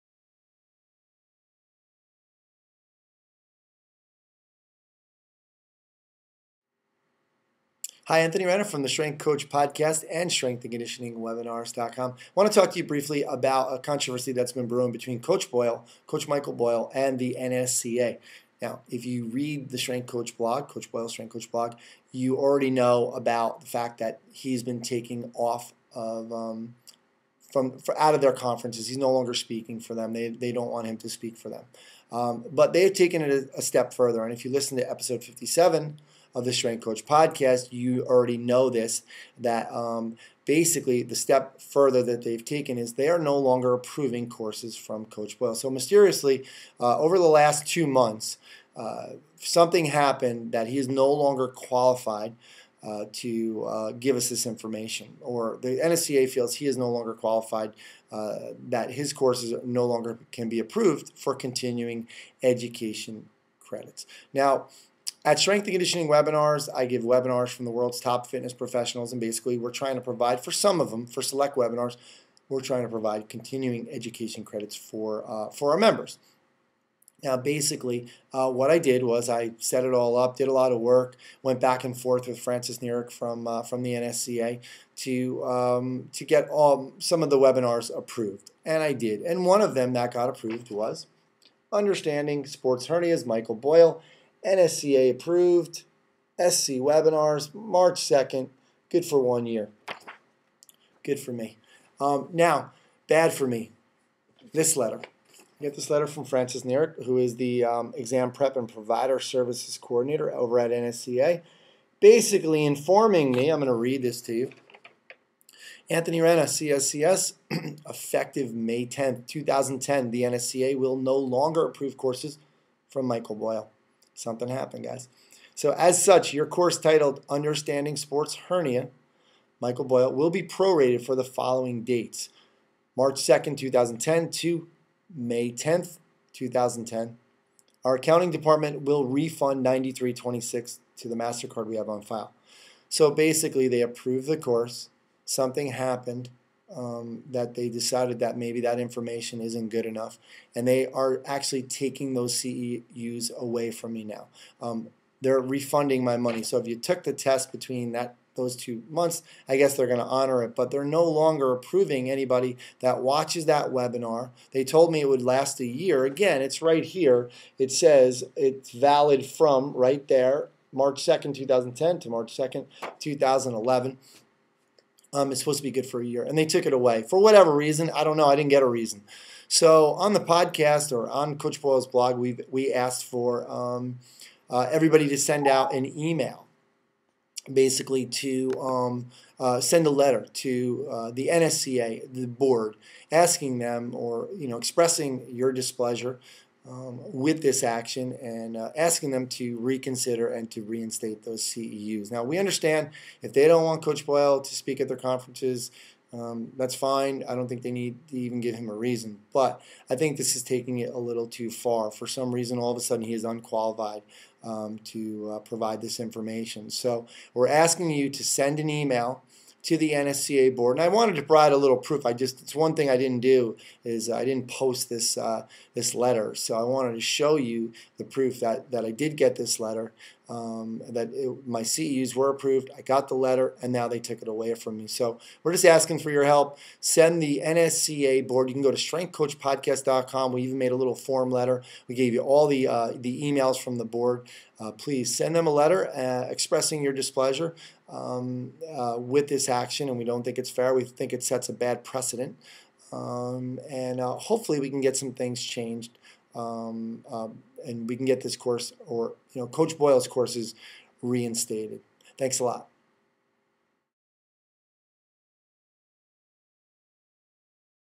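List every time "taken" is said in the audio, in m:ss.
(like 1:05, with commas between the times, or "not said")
0:32, 0:42.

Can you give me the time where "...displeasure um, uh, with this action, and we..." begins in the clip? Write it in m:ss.
4:06.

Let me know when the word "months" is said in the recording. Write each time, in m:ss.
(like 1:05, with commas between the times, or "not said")
0:47, 2:38.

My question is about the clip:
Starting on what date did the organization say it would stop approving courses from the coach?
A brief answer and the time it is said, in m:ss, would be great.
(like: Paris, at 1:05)
May 10, 2010, at 1:58.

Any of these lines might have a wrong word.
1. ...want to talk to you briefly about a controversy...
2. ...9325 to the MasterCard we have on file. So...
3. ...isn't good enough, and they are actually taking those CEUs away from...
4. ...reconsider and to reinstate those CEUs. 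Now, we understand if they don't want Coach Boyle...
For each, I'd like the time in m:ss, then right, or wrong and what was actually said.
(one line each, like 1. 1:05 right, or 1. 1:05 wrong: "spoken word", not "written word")
1. 0:12 right
2. 2:19 wrong: "9326", not "9325"
3. 2:29 right
4. 3:19 right.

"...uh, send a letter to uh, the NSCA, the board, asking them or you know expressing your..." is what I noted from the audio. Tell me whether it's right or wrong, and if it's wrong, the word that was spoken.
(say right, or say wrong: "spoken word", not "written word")
right.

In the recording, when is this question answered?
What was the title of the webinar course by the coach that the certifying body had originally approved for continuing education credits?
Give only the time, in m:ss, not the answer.
1:31.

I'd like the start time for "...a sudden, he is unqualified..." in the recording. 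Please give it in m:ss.
3:32.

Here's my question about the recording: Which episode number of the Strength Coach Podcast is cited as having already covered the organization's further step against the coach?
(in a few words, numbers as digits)
57.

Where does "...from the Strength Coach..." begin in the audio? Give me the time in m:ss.
0:08.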